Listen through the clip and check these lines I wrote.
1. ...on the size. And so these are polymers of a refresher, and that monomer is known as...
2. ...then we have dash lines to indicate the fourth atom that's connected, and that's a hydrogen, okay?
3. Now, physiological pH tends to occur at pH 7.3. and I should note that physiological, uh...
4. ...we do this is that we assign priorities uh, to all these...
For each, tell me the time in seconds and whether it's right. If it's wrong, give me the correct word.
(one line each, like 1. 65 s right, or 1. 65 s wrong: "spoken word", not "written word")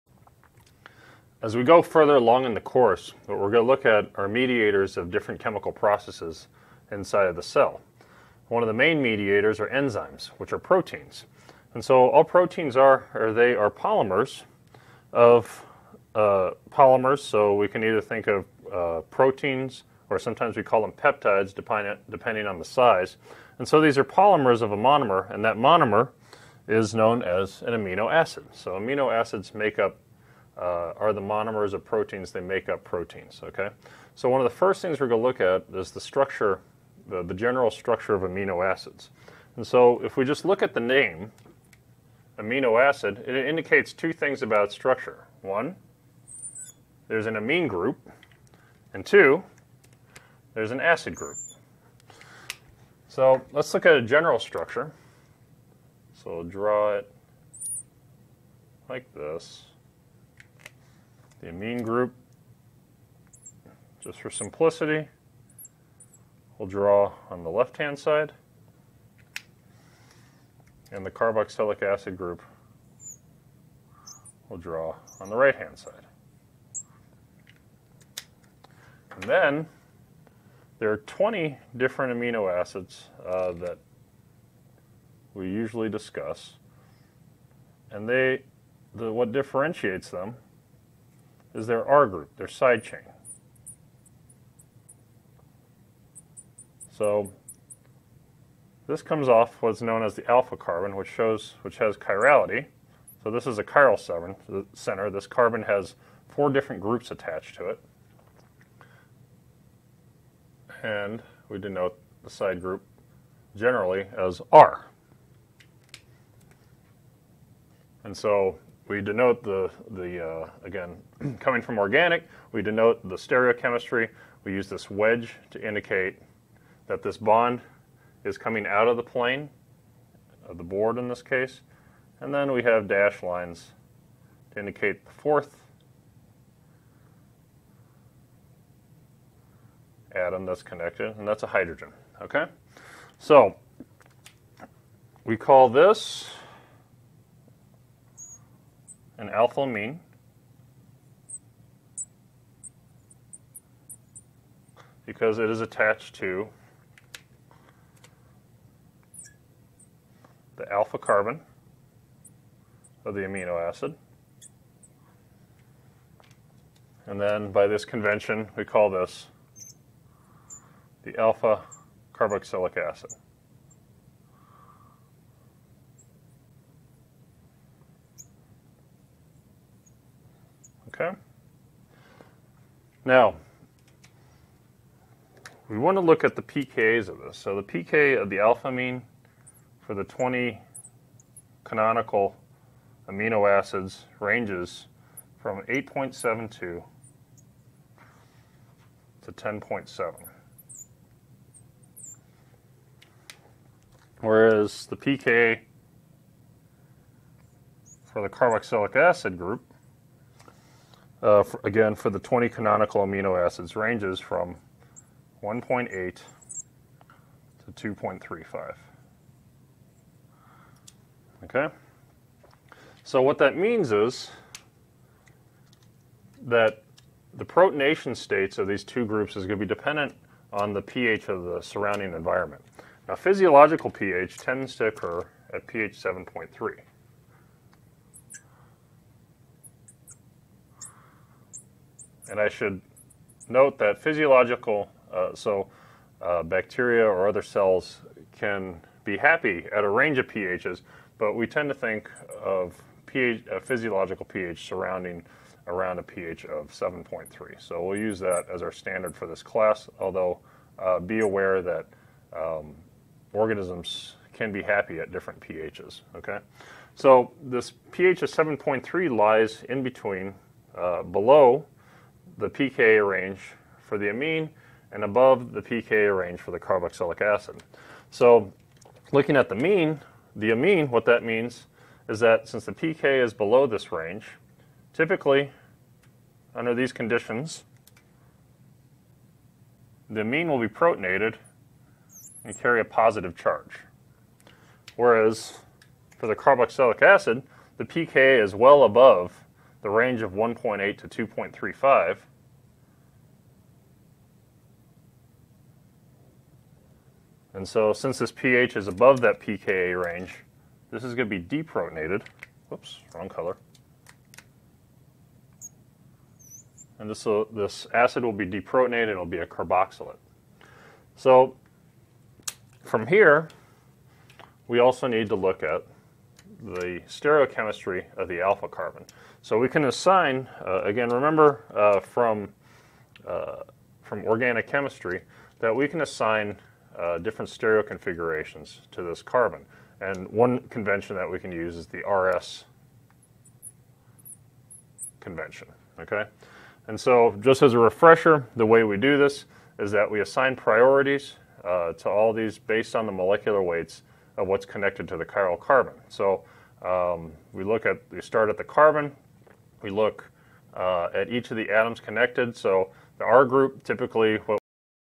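1. 22 s wrong: "monomer", not "refresher"
2. 132 s right
3. 233 s right
4. 348 s right.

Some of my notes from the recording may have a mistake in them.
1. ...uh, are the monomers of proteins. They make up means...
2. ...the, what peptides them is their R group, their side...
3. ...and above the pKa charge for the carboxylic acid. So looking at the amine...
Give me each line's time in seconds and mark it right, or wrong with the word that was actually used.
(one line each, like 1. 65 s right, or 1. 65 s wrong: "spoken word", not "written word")
1. 30 s wrong: "proteins", not "means"
2. 88 s wrong: "differentiates", not "peptides"
3. 274 s wrong: "range", not "charge".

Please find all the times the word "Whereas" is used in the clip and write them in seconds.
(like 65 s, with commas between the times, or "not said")
204 s, 294 s.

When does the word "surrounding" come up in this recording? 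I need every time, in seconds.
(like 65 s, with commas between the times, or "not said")
231 s, 254 s.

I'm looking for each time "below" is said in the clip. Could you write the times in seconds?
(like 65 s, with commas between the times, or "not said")
271 s, 283 s.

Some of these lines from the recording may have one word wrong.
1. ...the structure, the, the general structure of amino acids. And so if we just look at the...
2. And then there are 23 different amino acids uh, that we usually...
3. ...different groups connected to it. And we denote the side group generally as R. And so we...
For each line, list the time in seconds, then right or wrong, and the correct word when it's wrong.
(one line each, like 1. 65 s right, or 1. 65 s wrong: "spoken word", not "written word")
1. 35 s right
2. 79 s wrong: "20", not "23"
3. 106 s wrong: "attached", not "connected".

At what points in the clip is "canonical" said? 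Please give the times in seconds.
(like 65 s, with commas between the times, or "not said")
191 s, 212 s.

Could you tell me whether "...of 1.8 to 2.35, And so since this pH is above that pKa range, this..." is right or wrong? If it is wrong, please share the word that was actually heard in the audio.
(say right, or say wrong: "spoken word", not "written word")
right.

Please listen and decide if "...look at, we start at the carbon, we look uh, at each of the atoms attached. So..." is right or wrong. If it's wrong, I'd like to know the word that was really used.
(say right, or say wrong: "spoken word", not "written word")
wrong: "connected", not "attached".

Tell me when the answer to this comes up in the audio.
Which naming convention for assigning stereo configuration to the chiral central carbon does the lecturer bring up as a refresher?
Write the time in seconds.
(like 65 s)
341 s.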